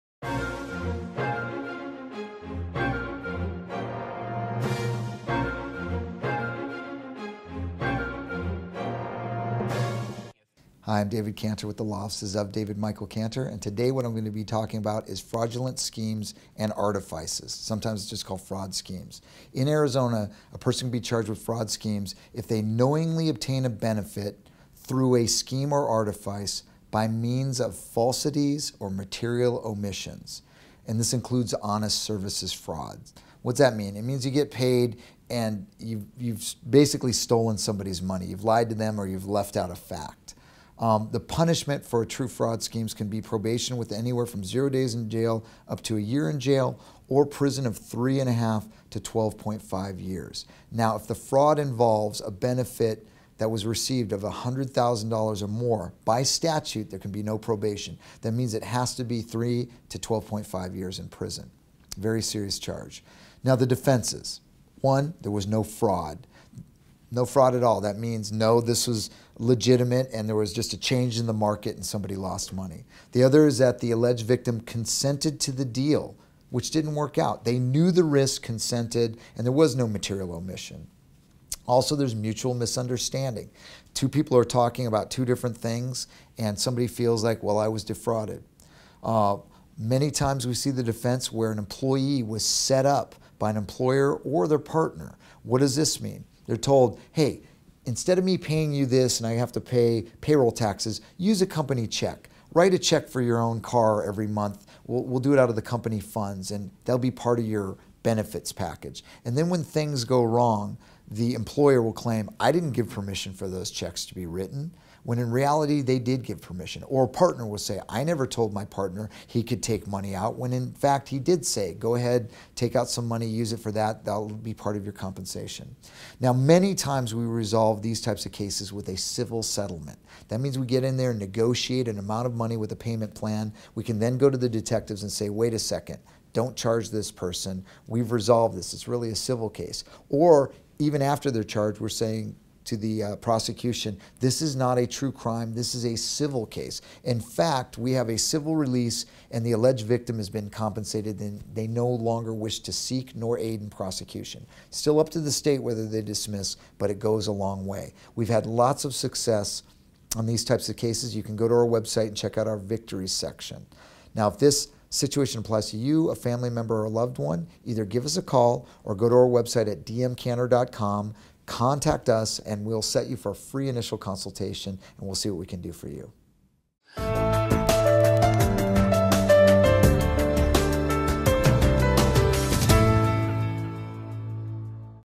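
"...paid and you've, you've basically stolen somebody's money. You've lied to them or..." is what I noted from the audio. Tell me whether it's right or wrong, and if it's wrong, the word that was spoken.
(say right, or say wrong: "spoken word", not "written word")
right.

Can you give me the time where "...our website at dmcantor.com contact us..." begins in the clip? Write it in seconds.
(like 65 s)
169 s.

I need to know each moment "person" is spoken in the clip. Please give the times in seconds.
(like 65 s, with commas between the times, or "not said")
20 s, 137 s.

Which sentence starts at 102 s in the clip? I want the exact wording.
Write a check for your own car every month.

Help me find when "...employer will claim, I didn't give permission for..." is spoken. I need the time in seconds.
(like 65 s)
111 s.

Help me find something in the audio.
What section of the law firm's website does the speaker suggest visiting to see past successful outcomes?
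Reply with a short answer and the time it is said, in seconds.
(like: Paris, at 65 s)
Victories section, at 162 s.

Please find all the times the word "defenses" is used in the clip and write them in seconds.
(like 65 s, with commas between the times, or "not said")
63 s, 90 s.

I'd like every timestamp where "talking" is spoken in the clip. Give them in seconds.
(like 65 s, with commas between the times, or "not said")
14 s, 84 s.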